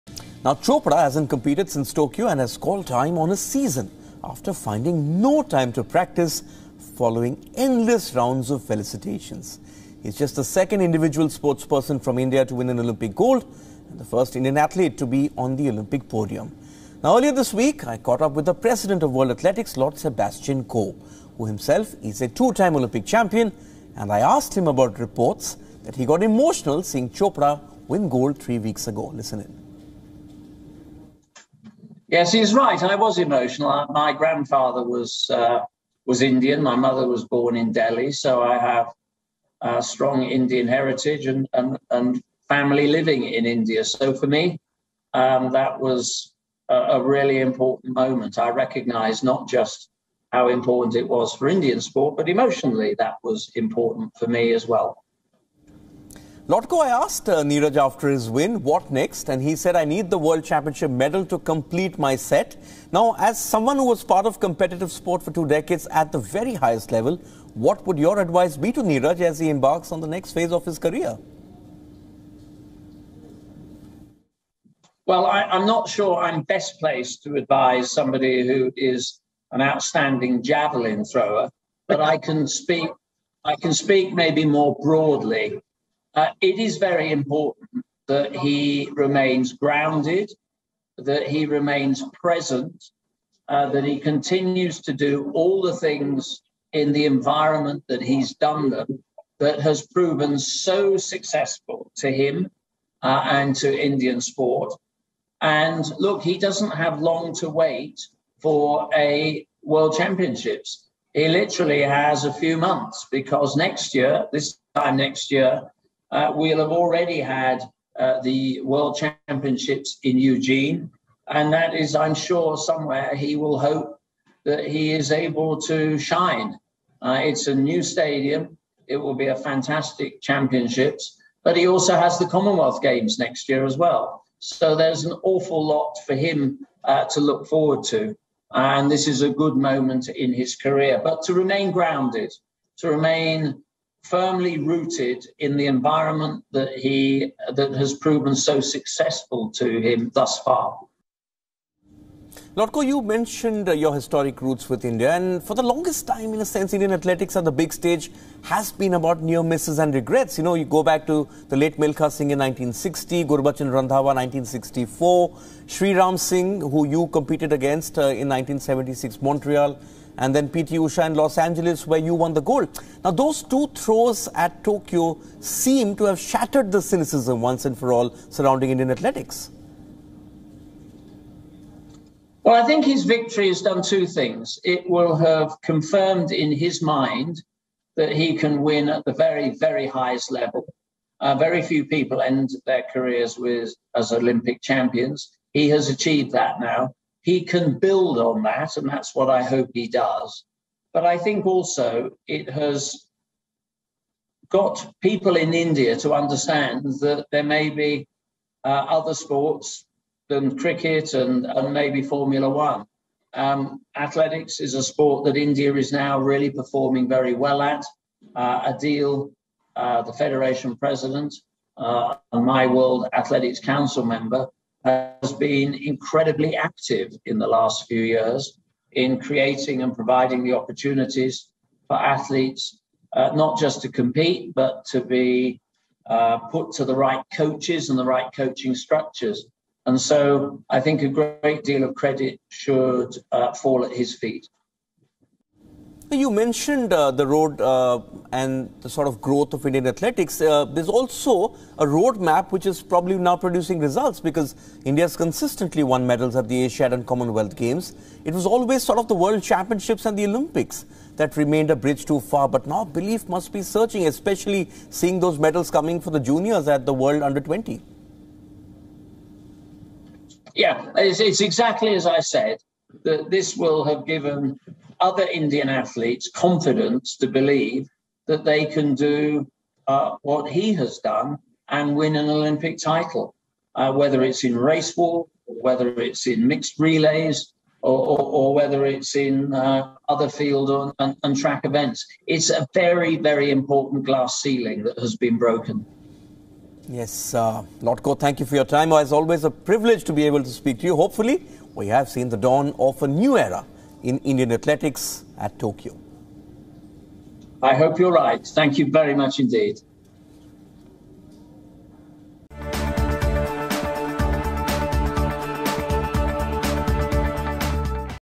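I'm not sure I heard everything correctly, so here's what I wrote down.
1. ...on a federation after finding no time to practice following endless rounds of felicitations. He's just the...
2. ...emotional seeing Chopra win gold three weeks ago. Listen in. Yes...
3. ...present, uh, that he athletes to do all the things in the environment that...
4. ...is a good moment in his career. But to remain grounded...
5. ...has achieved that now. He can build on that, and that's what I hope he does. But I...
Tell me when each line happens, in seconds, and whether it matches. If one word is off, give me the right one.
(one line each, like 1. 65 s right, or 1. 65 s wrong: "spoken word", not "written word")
1. 3 s wrong: "season", not "federation"
2. 26 s right
3. 92 s wrong: "continues", not "athletes"
4. 139 s right
5. 195 s right.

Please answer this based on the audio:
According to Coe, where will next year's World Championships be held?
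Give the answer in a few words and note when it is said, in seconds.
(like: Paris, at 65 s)
Eugene, at 120 s.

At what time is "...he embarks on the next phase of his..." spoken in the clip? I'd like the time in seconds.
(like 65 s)
69 s.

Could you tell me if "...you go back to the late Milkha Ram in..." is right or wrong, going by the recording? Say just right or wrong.
wrong.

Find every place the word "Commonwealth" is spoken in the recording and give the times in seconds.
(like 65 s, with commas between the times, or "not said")
132 s, 257 s.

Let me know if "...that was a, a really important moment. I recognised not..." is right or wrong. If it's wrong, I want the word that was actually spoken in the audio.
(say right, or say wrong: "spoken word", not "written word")
right.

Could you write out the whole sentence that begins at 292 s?
It's a very, very important glass ceiling that has been broken.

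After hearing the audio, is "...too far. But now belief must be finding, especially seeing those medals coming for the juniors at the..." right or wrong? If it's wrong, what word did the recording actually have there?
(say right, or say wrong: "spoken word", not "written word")
wrong: "searching", not "finding".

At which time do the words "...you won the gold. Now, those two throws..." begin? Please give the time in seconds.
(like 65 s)
172 s.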